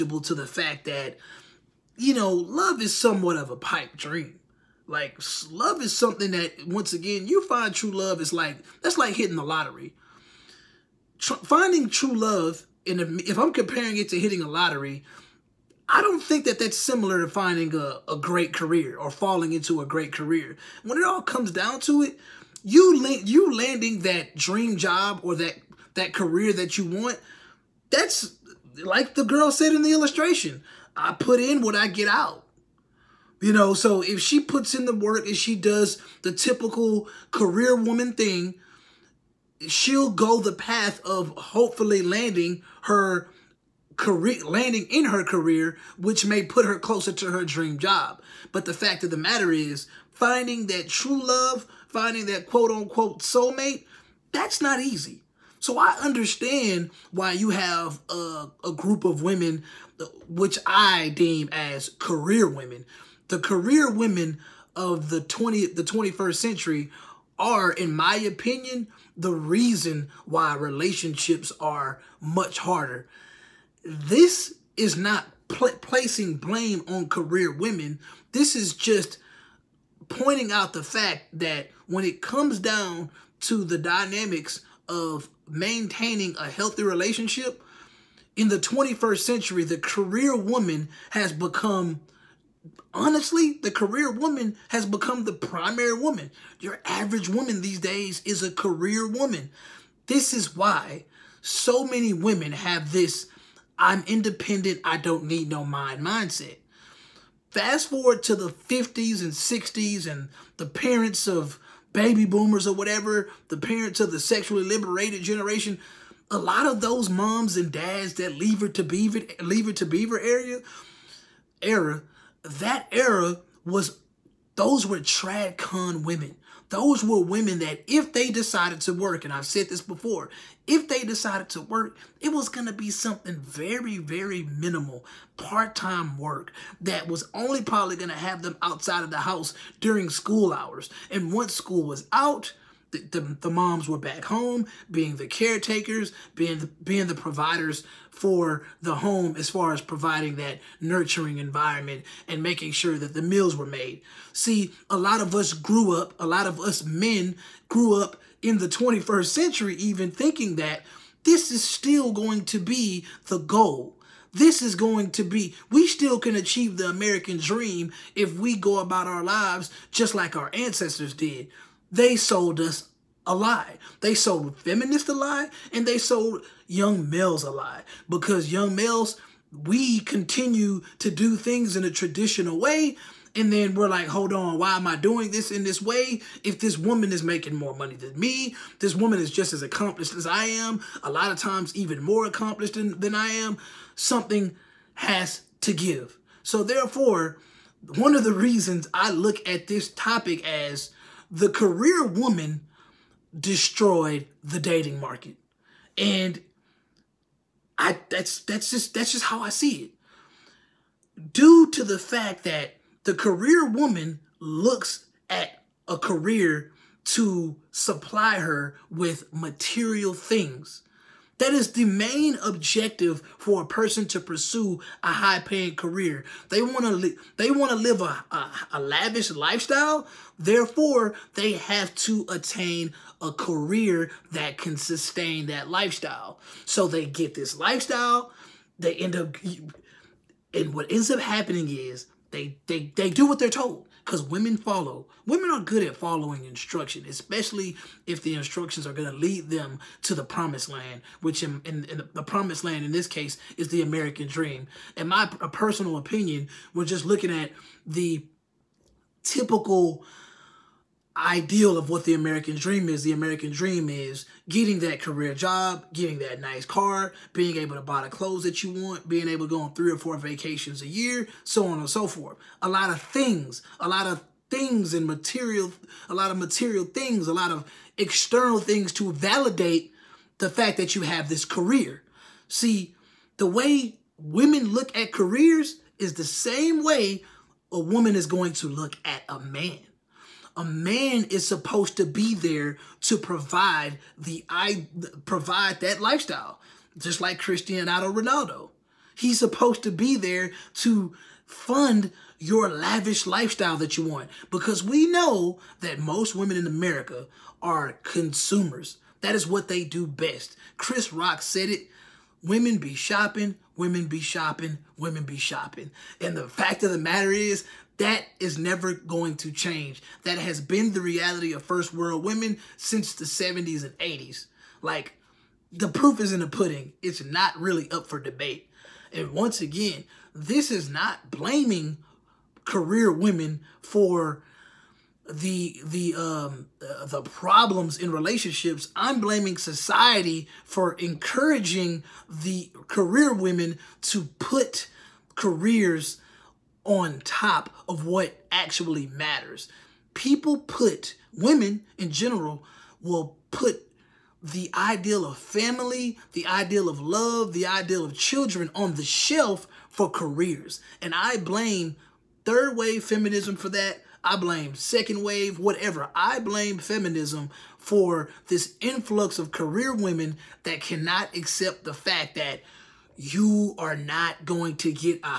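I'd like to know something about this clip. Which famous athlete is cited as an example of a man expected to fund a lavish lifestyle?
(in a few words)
Cristiano Ronaldo.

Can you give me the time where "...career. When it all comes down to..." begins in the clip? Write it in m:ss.
0:20.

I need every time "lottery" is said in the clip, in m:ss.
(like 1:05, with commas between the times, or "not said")
0:09, 0:14.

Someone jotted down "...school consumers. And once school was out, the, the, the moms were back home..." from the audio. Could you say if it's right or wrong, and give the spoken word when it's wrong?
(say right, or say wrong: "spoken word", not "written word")
wrong: "hours", not "consumers".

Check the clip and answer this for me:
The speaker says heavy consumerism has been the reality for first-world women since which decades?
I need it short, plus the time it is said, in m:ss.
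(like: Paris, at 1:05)
1970s and 1980s, at 5:23.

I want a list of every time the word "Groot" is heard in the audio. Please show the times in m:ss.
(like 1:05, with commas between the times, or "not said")
not said.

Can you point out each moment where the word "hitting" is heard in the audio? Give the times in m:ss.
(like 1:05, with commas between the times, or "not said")
0:09, 0:14.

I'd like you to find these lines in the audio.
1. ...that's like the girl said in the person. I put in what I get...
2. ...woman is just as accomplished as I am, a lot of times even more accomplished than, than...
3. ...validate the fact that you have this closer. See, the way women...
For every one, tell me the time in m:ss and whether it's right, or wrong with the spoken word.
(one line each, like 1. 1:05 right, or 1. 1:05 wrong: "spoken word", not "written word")
1. 0:27 wrong: "illustration", not "person"
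2. 3:08 right
3. 4:39 wrong: "career", not "closer".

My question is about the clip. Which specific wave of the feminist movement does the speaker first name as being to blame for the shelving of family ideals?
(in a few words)
Third wave.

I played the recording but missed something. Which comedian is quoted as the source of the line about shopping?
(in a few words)
Chris Rock.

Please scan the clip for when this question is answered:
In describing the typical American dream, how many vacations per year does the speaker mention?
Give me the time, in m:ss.
4:29.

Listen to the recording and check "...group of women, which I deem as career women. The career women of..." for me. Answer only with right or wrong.
right.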